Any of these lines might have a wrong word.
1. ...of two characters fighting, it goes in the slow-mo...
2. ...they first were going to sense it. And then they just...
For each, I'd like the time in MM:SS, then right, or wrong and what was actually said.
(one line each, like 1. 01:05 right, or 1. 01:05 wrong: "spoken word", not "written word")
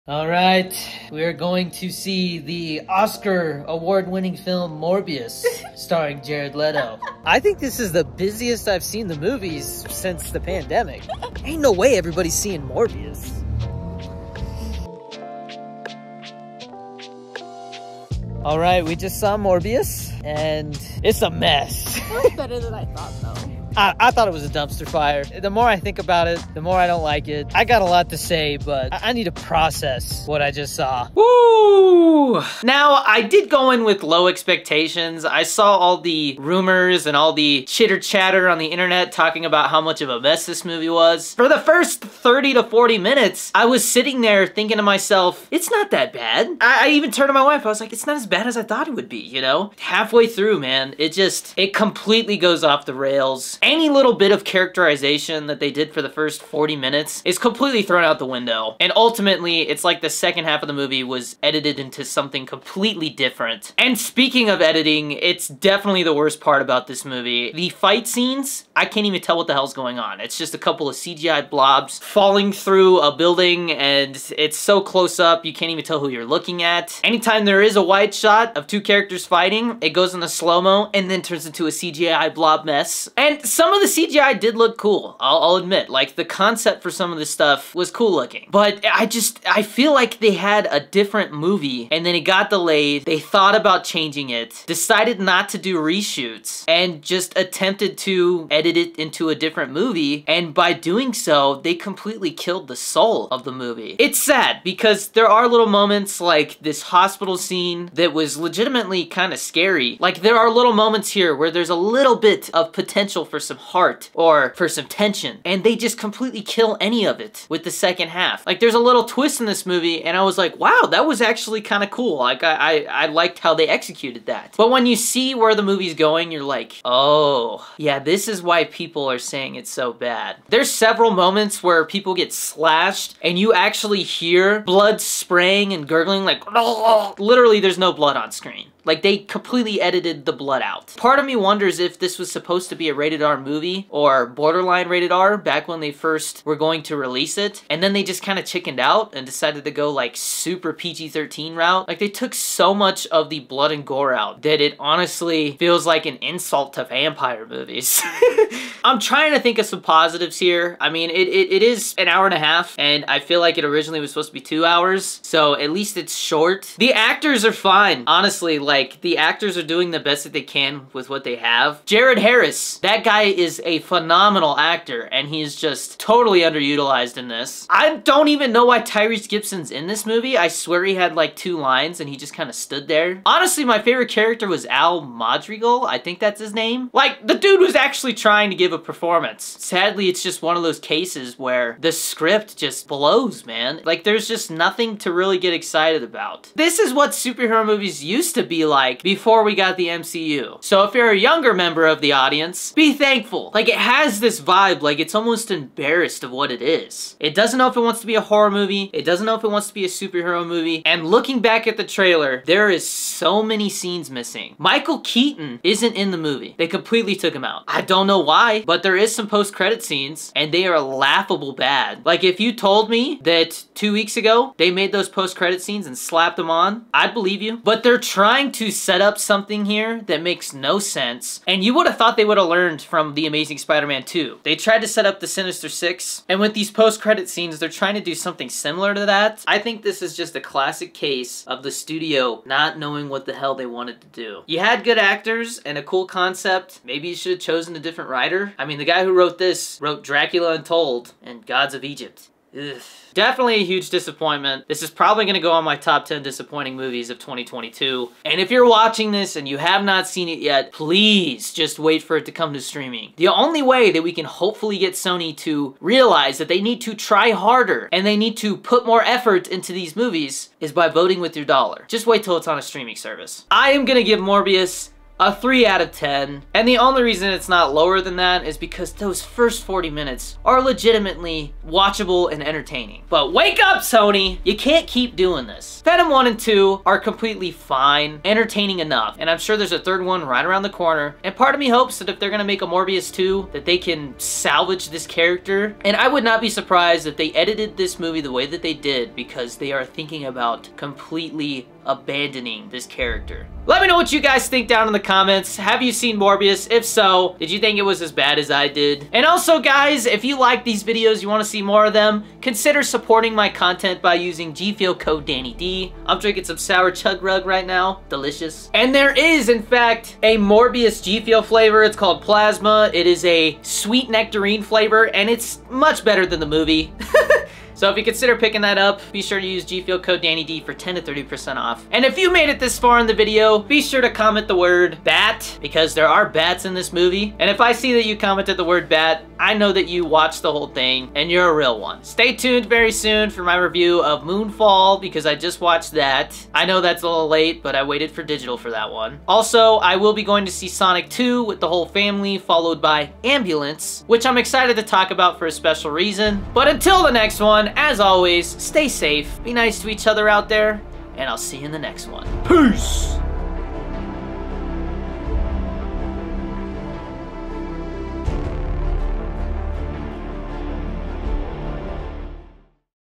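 1. 01:18 right
2. 02:25 wrong: "release", not "sense".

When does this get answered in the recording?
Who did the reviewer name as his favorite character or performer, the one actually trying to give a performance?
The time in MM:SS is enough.
03:04.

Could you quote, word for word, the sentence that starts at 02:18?
Like they completely edited the blood cut out.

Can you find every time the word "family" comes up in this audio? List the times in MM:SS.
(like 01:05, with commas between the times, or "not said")
05:51.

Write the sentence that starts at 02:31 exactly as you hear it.
Like they took so much of the blood and gore out that it honestly feels like an insult to vampire movies.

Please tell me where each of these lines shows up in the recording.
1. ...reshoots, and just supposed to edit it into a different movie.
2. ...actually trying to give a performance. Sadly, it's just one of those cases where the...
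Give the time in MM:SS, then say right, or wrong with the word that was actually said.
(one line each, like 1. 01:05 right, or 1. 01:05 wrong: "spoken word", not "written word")
1. 01:35 wrong: "attempted", not "supposed"
2. 03:07 right.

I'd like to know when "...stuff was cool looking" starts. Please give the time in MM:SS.
01:27.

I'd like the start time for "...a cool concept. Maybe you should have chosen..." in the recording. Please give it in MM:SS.
04:05.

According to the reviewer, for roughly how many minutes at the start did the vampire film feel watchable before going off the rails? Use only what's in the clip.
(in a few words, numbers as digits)
30 to 40 minutes.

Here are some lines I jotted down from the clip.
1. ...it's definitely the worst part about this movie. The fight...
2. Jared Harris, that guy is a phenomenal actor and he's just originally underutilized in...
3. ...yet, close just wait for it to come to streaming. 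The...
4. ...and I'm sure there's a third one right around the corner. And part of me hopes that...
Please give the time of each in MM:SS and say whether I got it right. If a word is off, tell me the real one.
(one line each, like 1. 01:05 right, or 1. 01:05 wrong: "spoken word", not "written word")
1. 01:05 right
2. 02:51 wrong: "totally", not "originally"
3. 04:20 wrong: "please", not "close"
4. 04:49 right.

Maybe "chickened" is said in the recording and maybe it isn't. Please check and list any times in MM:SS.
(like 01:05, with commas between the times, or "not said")
02:28.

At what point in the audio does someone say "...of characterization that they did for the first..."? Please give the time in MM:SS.
00:54.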